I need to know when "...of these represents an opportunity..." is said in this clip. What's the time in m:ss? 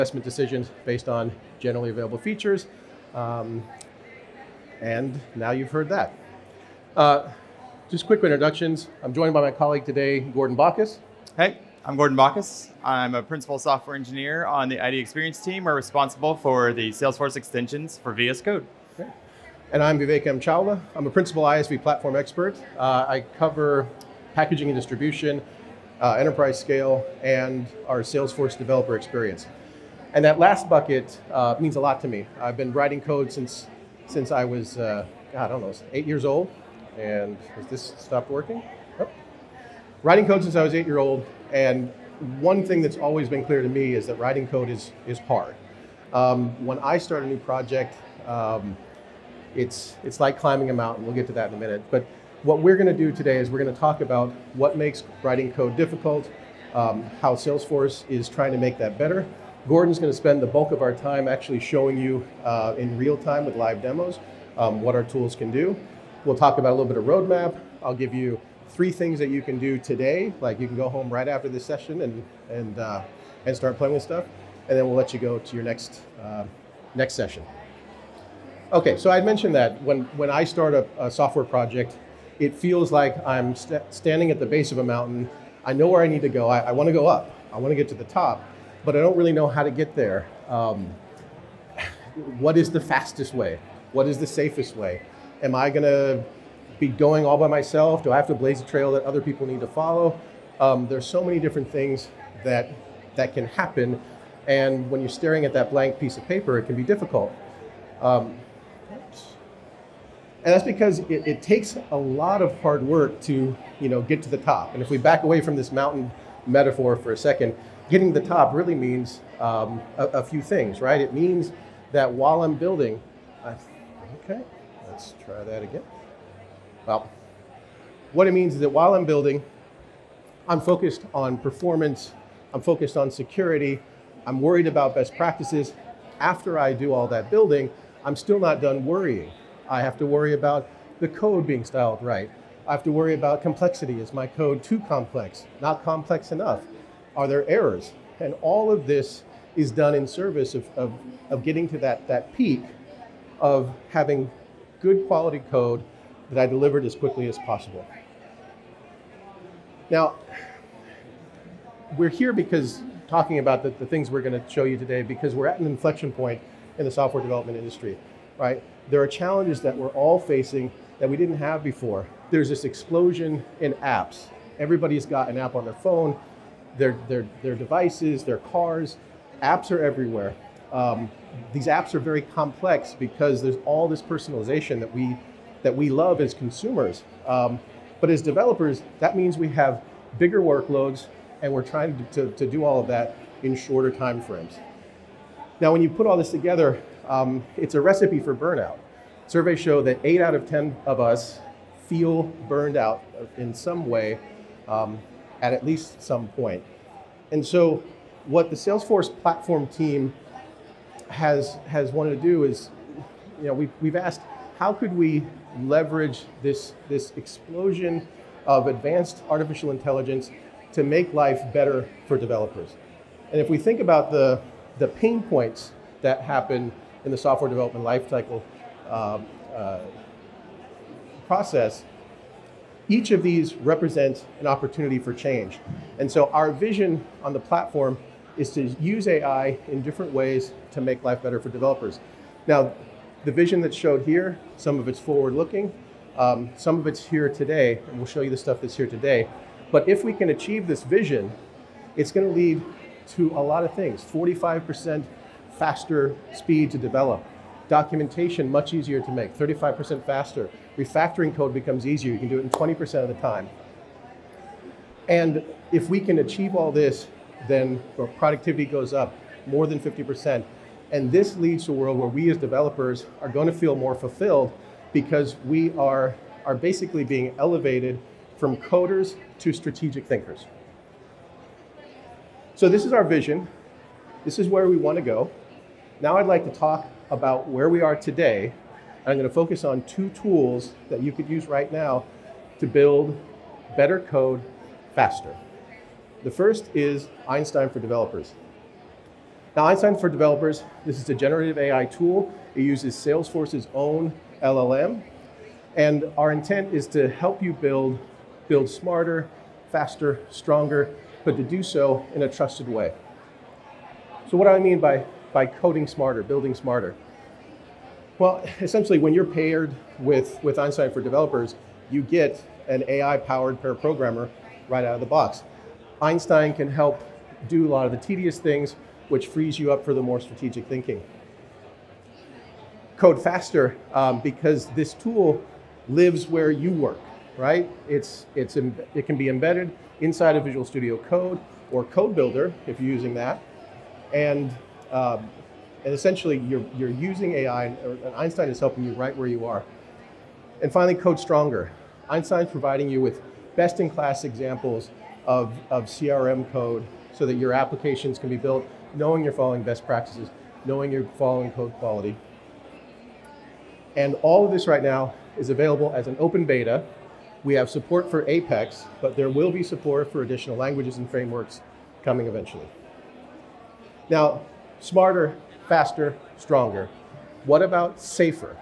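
3:53.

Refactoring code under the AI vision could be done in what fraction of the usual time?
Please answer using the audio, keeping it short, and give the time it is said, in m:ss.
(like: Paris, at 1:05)
20%, at 4:22.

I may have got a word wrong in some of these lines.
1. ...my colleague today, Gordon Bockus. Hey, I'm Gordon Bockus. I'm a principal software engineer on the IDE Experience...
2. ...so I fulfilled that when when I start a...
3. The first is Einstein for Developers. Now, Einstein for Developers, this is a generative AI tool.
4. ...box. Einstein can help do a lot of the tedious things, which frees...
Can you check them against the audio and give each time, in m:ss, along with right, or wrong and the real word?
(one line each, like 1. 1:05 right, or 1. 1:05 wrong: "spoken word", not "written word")
1. 0:09 right
2. 1:18 wrong: "mentioned", not "fulfilled"
3. 4:56 right
4. 5:25 right.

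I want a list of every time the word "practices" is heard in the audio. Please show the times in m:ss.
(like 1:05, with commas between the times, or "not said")
2:15, 5:59.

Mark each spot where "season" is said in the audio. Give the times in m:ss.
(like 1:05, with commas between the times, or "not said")
not said.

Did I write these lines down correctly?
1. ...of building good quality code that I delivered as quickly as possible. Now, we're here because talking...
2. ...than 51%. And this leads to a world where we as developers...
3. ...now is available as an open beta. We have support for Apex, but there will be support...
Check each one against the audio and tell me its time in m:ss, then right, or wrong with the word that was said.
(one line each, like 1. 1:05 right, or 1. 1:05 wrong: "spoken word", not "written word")
1. 2:33 wrong: "having", not "building"
2. 4:29 wrong: "50", not "51"
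3. 6:04 right.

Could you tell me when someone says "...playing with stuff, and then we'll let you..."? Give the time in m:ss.
1:13.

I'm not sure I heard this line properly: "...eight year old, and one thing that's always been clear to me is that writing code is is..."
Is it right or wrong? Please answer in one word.
right.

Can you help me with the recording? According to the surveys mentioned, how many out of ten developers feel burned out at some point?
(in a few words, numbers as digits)
8.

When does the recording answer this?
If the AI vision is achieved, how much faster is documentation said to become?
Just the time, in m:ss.
4:19.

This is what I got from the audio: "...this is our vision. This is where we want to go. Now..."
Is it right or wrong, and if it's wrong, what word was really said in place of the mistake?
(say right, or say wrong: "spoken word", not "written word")
right.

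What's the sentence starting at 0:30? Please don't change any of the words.
And that last bucket uh, means a lot to me.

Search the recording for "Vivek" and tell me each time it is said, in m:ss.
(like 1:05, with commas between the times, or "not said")
0:19.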